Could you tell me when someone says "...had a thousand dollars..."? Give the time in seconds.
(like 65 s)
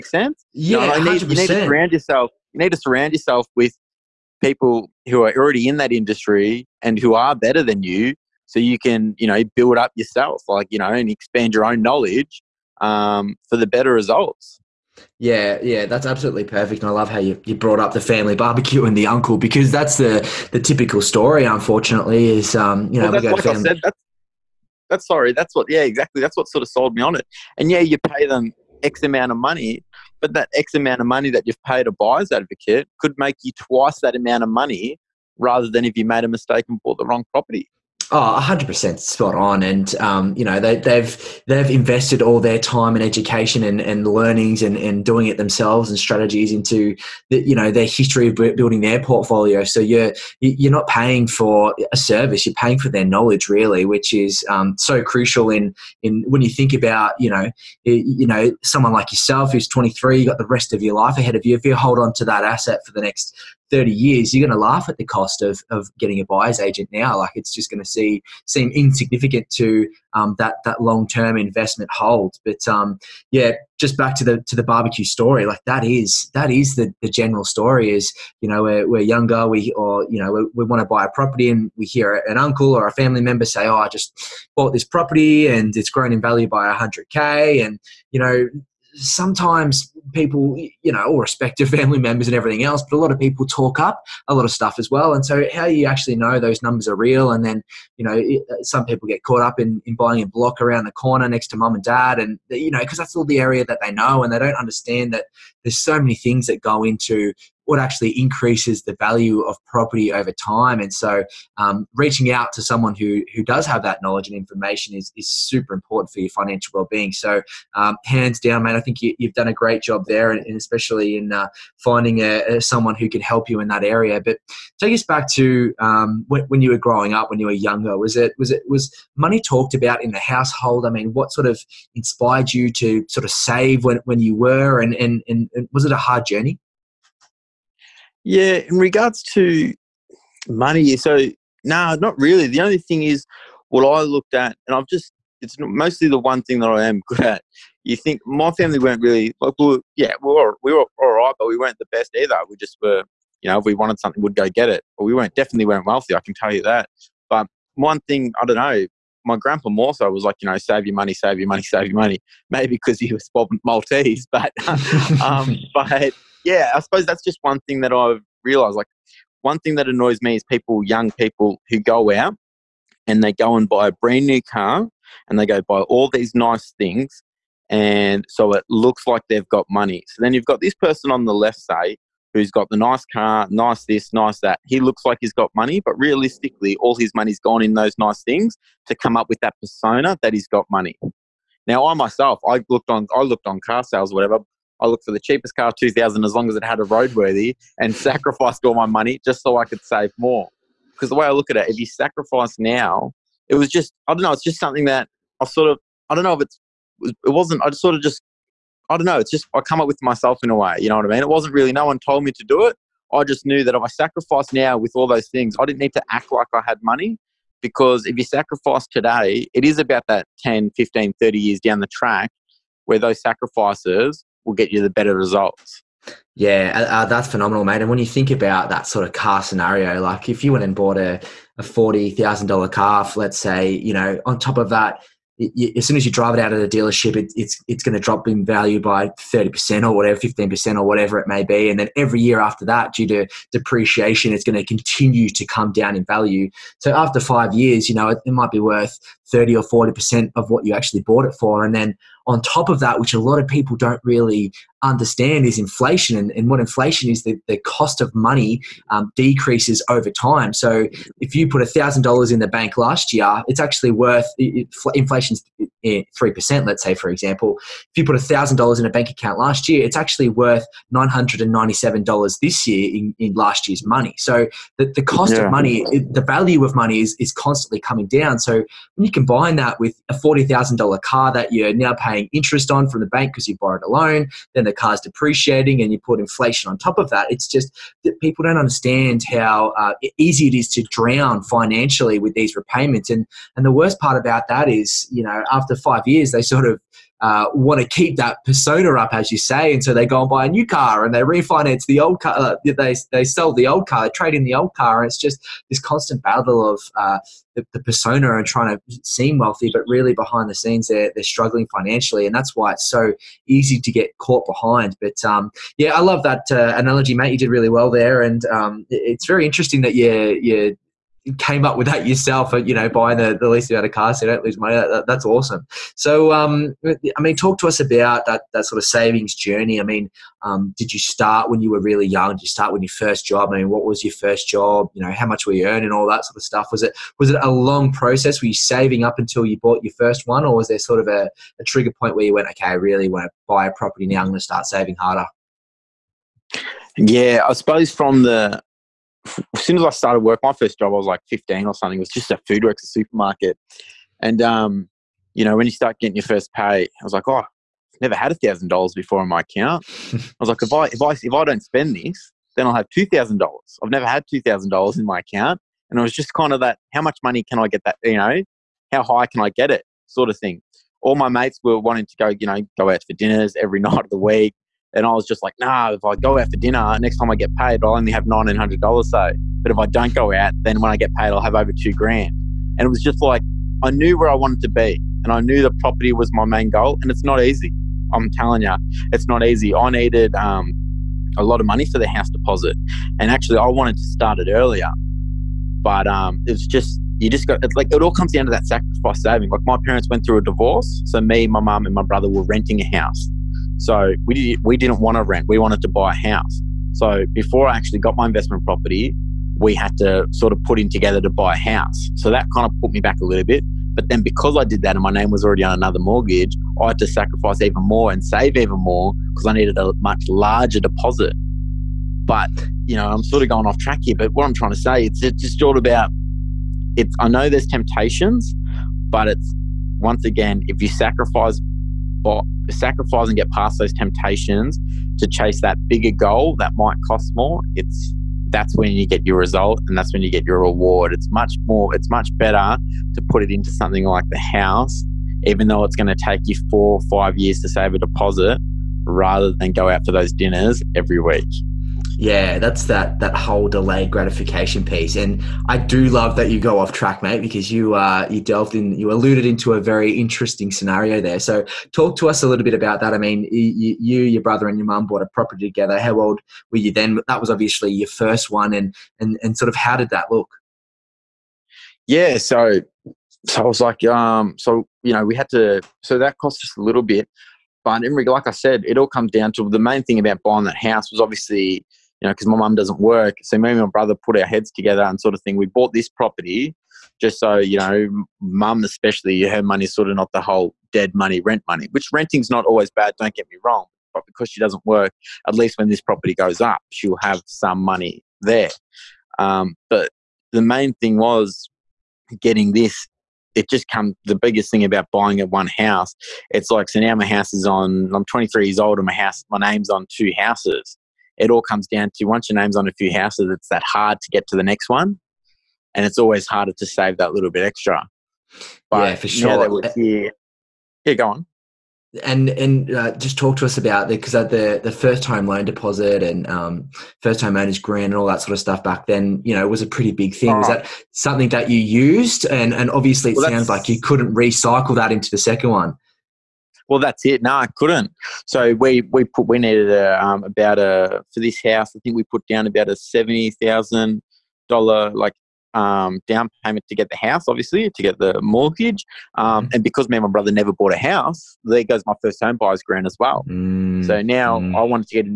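358 s.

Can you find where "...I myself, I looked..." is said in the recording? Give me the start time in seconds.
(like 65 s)
191 s.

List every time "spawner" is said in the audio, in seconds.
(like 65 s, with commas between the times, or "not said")
not said.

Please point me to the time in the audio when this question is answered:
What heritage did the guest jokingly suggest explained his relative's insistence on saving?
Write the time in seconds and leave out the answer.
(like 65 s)
163 s.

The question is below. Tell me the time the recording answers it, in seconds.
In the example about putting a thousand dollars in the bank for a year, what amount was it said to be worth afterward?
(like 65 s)
270 s.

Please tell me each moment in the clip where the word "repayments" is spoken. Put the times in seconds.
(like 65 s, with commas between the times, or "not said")
292 s.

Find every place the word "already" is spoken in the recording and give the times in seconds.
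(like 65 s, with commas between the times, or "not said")
5 s, 415 s.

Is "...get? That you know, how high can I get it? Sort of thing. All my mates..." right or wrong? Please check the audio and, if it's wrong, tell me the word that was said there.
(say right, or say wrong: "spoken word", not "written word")
right.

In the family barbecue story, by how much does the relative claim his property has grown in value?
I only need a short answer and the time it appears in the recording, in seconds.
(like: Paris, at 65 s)
100K, at 86 s.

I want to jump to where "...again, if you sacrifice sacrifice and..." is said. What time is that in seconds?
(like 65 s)
430 s.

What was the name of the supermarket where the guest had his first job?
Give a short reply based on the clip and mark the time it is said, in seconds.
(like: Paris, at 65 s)
FoodWorks, at 352 s.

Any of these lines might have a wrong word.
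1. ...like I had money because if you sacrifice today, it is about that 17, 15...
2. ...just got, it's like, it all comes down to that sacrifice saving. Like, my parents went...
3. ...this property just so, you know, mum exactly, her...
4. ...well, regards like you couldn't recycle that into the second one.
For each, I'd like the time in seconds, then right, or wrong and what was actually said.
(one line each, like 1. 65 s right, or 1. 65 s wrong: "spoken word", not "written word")
1. 216 s wrong: "10", not "17"
2. 397 s right
3. 485 s wrong: "especially", not "exactly"
4. 533 s wrong: "sounds", not "regards".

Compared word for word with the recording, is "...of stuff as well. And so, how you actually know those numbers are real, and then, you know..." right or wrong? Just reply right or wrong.
right.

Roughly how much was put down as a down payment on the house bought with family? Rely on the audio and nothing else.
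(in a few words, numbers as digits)
$70,000.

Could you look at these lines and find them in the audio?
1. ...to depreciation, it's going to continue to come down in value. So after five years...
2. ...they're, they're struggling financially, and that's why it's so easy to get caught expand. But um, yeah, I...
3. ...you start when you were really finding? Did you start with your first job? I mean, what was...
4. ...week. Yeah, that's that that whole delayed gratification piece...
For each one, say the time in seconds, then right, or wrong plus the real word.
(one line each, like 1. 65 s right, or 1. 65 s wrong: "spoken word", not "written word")
1. 243 s right
2. 310 s wrong: "behind", not "expand"
3. 330 s wrong: "young", not "finding"
4. 451 s right.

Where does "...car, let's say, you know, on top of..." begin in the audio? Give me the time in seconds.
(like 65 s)
232 s.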